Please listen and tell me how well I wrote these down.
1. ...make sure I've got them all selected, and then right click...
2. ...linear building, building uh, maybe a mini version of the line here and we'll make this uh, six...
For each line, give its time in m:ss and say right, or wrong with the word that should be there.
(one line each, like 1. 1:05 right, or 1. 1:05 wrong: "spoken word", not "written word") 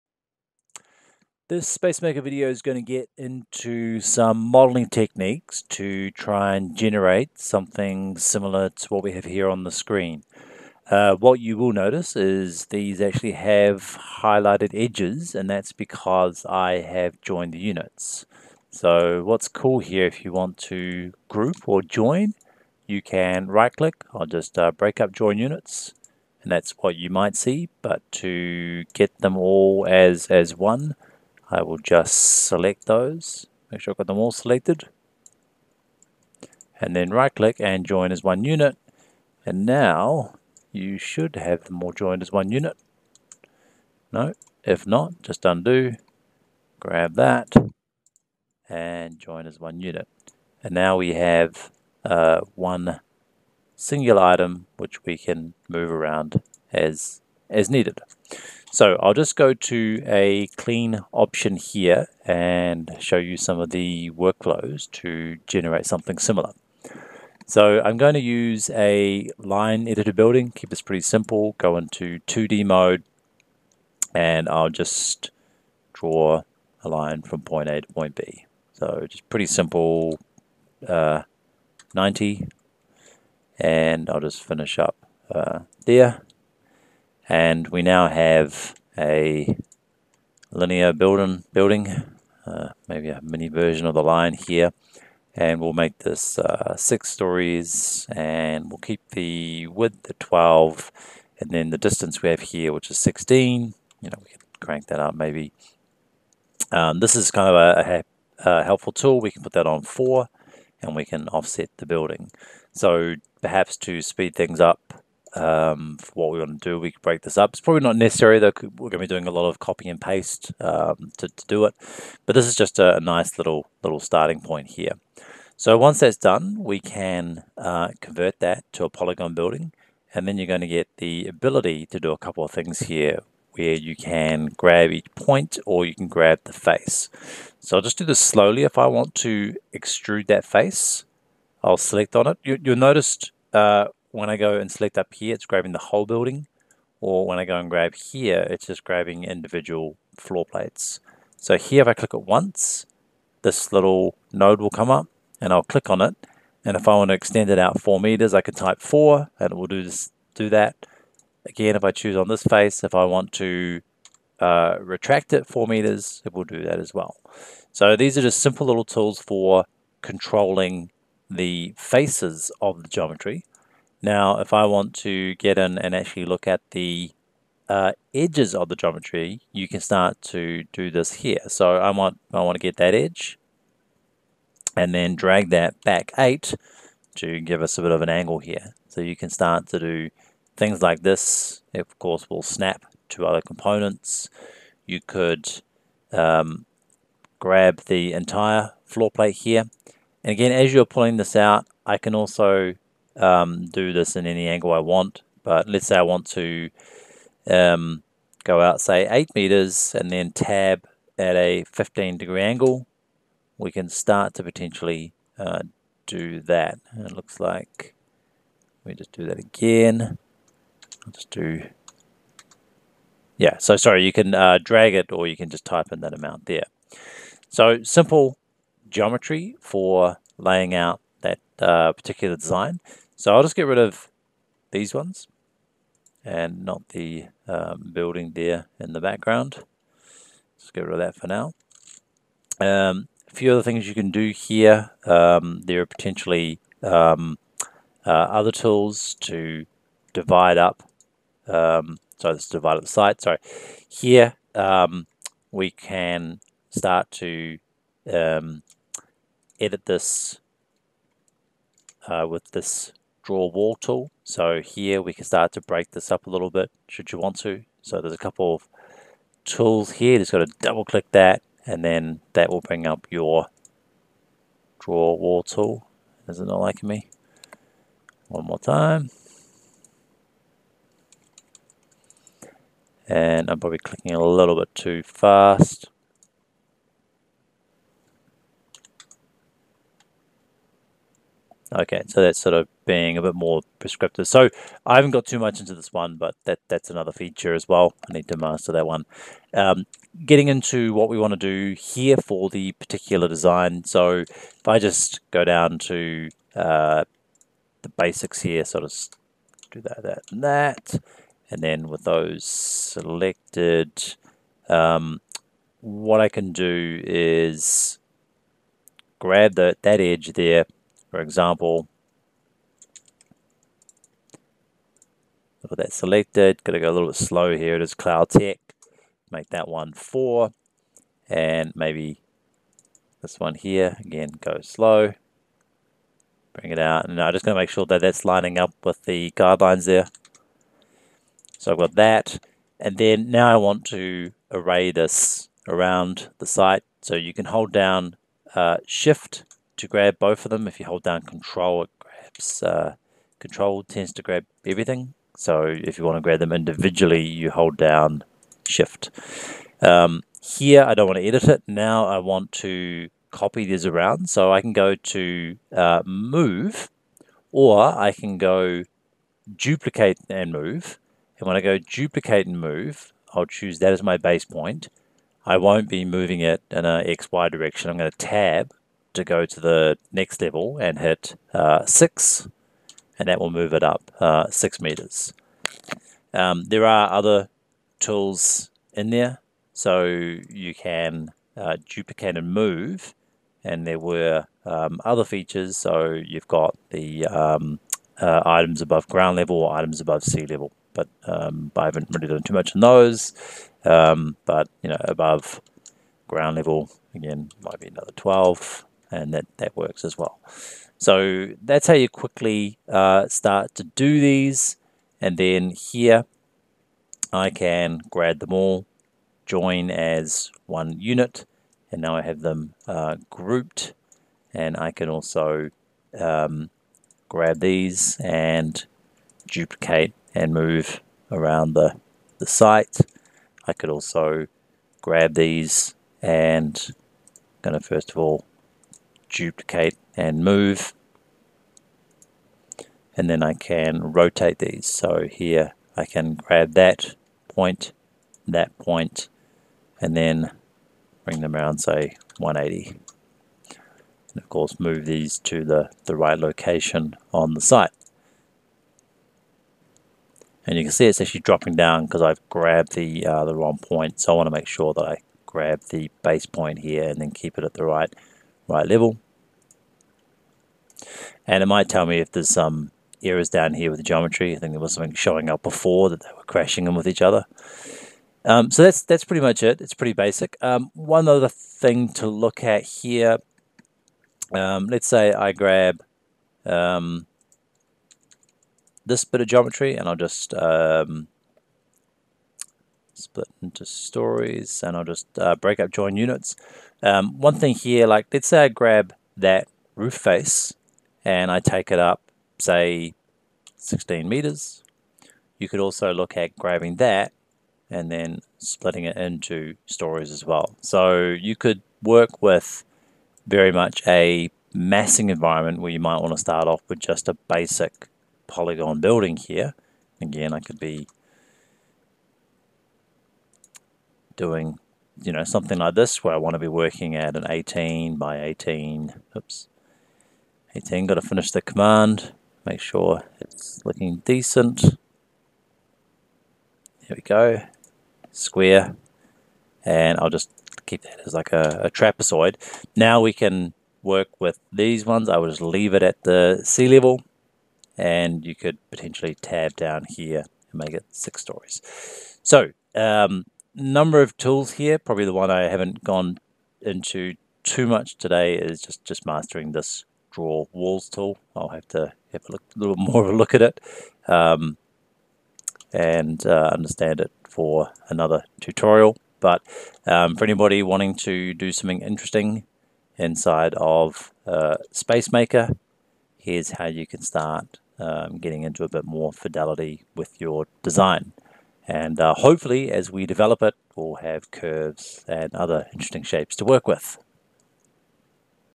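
1. 0:33 right
2. 1:30 right.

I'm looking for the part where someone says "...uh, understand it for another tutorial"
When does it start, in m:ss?
9:26.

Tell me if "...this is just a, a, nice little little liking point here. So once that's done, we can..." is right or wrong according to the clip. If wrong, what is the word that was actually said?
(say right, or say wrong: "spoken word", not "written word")
wrong: "starting", not "liking".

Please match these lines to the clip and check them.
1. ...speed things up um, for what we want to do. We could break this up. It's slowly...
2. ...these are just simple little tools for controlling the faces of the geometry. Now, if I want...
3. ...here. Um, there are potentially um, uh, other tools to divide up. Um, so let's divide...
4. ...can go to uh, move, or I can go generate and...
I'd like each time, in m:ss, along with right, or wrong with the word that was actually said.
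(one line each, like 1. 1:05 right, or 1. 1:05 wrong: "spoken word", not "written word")
1. 1:54 wrong: "probably", not "slowly"
2. 2:47 right
3. 4:04 right
4. 6:04 wrong: "duplicate", not "generate".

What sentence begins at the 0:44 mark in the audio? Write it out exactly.
No, if not, just undo, grab that, and join as one unit.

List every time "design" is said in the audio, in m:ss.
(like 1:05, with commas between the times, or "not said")
3:52, 5:03, 9:40.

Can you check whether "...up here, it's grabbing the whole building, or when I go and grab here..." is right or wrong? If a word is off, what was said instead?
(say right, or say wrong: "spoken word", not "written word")
right.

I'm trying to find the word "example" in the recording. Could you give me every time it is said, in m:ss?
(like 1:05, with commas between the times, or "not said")
5:21.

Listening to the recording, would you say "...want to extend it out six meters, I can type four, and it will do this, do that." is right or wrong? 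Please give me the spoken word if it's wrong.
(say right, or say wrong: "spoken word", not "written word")
wrong: "four", not "six".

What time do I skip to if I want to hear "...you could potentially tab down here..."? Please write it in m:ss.
9:08.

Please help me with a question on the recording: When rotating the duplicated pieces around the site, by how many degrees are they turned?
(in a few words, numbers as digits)
180.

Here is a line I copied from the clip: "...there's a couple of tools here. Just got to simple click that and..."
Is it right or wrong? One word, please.
wrong.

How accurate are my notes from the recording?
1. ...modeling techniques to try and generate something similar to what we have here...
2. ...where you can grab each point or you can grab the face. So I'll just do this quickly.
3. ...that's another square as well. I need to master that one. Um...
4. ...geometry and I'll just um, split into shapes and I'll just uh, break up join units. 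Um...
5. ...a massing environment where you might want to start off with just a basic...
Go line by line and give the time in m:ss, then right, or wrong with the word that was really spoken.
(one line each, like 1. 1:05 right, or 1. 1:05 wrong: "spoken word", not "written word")
1. 0:04 right
2. 2:13 wrong: "slowly", not "quickly"
3. 4:56 wrong: "feature", not "square"
4. 8:09 wrong: "stories", not "shapes"
5. 8:34 right.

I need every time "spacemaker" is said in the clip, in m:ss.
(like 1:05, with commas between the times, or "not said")
0:01, 9:34.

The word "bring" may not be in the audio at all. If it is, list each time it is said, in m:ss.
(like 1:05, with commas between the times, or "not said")
4:32, 5:36, 7:31.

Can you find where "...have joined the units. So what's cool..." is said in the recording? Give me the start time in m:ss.
0:16.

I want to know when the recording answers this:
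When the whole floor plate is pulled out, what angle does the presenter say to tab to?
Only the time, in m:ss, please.
3:31.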